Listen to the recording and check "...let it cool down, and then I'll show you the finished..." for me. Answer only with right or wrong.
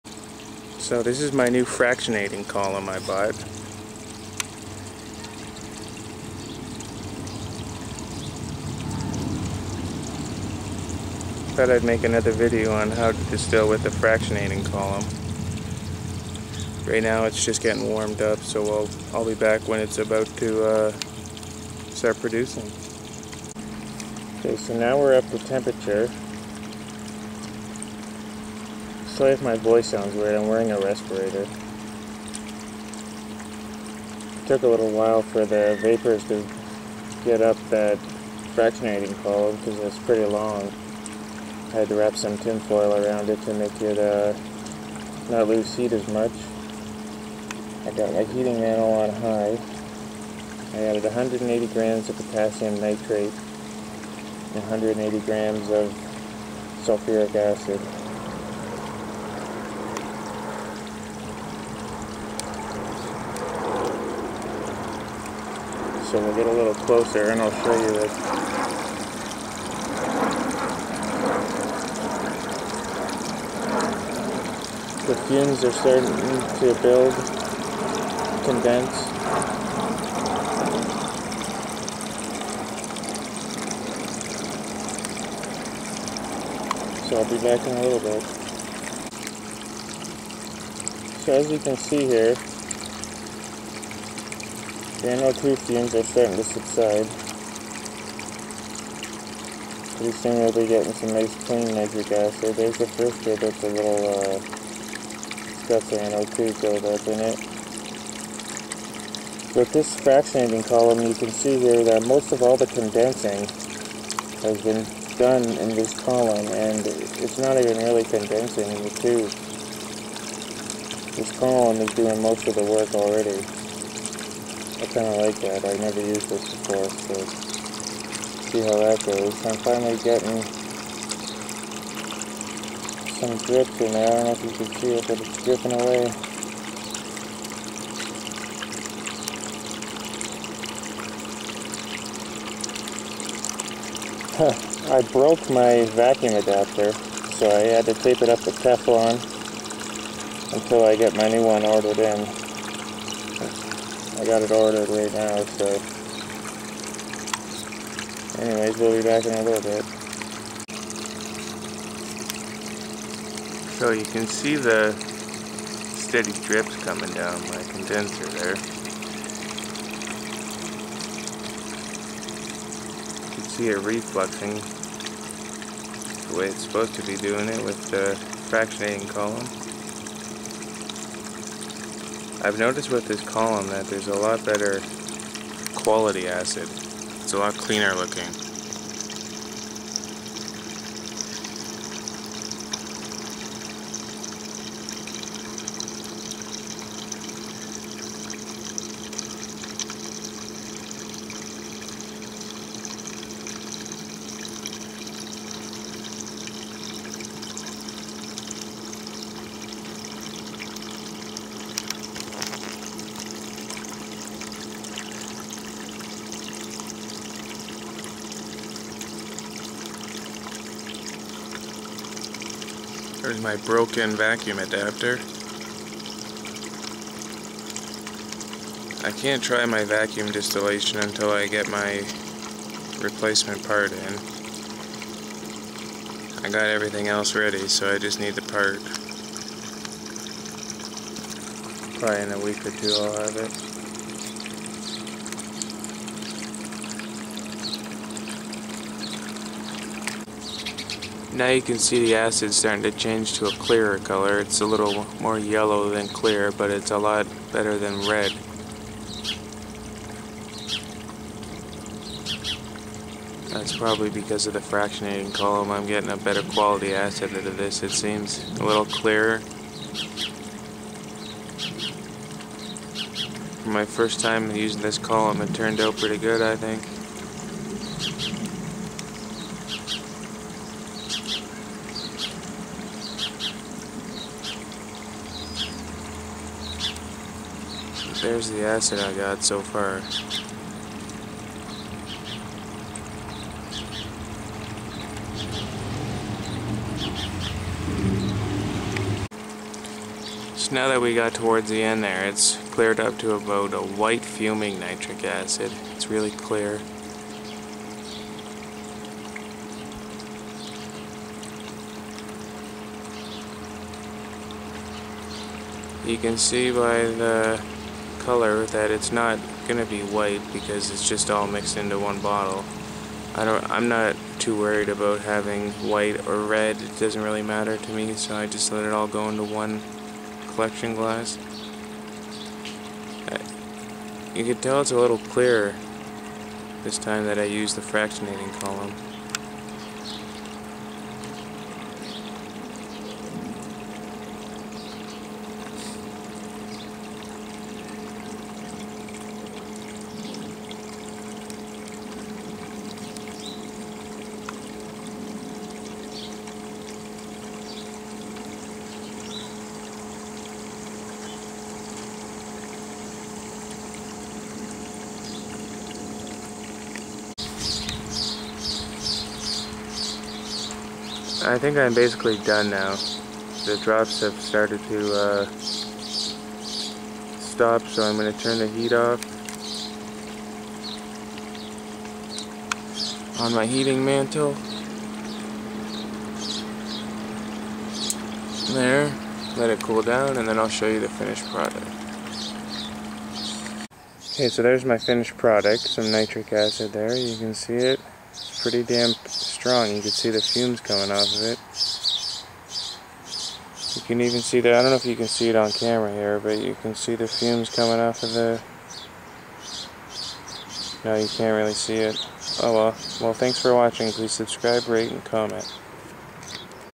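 right.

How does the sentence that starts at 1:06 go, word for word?
so we'll get a little closer and I'll show you this.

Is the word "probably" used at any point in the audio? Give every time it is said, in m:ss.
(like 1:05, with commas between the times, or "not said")
4:01, 4:23.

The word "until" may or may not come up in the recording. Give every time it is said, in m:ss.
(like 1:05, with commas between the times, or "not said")
2:30, 3:51.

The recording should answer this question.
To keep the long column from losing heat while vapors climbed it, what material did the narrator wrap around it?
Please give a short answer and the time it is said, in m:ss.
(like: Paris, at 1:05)
tinfoil, at 0:42.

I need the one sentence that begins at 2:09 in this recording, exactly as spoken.
I'm finally getting some drip in there.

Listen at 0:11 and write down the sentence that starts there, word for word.
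Thought I'd make another video on how to distill with the fractionating column.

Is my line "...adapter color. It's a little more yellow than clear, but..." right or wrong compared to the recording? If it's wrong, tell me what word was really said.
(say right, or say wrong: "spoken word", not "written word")
wrong: "clearer", not "adapter".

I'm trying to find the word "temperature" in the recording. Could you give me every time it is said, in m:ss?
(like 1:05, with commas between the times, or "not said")
0:25.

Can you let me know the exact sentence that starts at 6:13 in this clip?
The drops have started to uh, stop, so I'm going to turn the heat off on my heating mantle.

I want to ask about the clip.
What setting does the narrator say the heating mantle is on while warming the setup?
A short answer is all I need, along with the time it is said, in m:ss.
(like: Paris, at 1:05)
high, at 0:49.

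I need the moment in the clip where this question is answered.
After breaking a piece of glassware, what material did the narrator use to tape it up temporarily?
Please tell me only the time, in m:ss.
2:28.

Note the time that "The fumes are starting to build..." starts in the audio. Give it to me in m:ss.
1:15.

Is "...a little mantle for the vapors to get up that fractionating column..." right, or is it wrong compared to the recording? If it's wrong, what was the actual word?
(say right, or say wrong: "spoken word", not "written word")
wrong: "while", not "mantle".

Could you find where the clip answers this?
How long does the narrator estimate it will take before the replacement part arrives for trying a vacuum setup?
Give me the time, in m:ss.
4:02.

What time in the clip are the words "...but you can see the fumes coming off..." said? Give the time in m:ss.
6:46.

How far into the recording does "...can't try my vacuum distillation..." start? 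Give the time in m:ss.
3:49.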